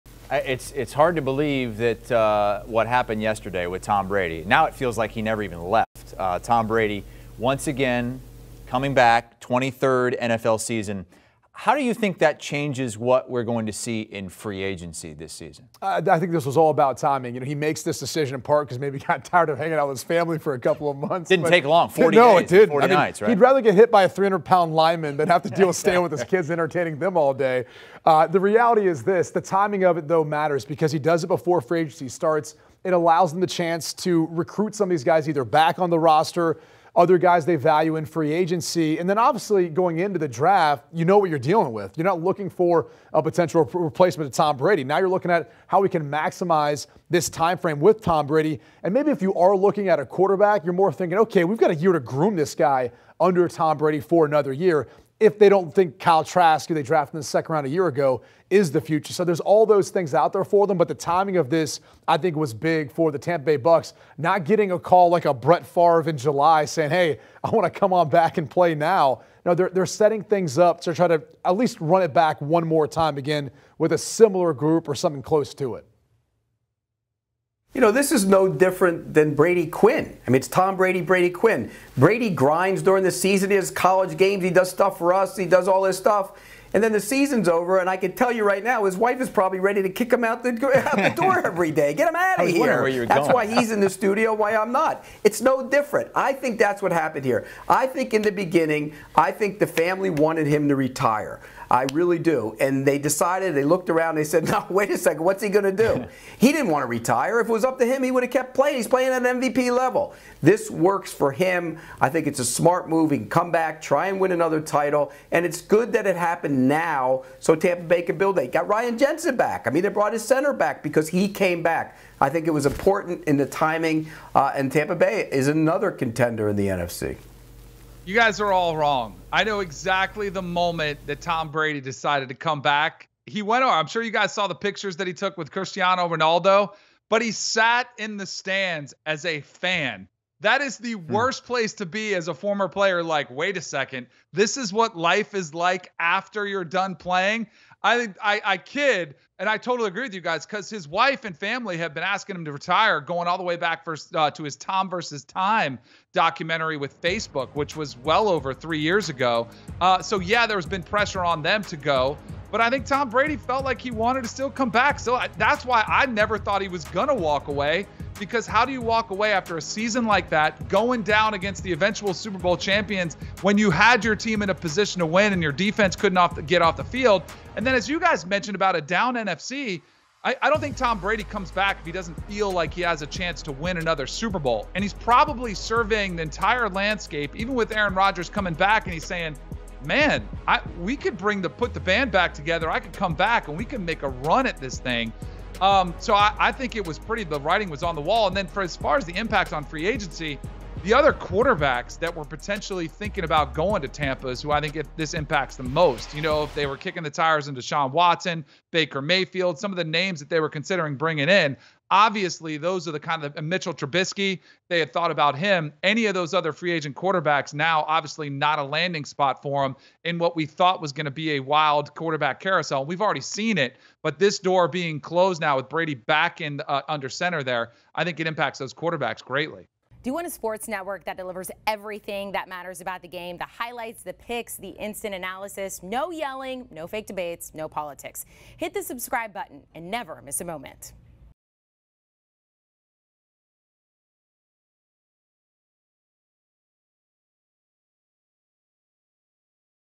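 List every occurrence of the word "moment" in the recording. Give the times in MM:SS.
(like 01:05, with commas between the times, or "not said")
02:10, 04:00.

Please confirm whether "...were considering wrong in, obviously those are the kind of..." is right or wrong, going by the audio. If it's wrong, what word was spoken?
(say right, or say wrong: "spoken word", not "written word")
wrong: "bringing", not "wrong".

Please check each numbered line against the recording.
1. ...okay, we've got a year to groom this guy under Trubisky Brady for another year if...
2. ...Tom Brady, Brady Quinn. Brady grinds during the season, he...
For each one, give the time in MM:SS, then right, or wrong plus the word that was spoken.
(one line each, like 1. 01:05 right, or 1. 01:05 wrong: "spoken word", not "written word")
1. 00:51 wrong: "Tom", not "Trubisky"
2. 01:20 right.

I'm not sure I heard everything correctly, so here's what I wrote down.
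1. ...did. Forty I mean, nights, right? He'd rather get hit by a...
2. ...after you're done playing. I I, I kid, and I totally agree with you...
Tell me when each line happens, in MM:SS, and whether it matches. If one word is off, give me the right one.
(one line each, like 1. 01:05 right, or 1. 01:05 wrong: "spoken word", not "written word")
1. 00:22 right
2. 02:25 right.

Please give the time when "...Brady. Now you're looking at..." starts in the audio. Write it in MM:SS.
00:44.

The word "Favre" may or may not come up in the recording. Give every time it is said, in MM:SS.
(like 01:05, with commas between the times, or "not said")
01:05.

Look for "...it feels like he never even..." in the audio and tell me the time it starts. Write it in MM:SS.
00:04.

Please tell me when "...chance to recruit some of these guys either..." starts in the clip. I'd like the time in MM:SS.
00:33.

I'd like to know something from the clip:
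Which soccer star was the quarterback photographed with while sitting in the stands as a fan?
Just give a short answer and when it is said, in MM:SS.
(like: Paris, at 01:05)
Cristiano Ronaldo, at 02:15.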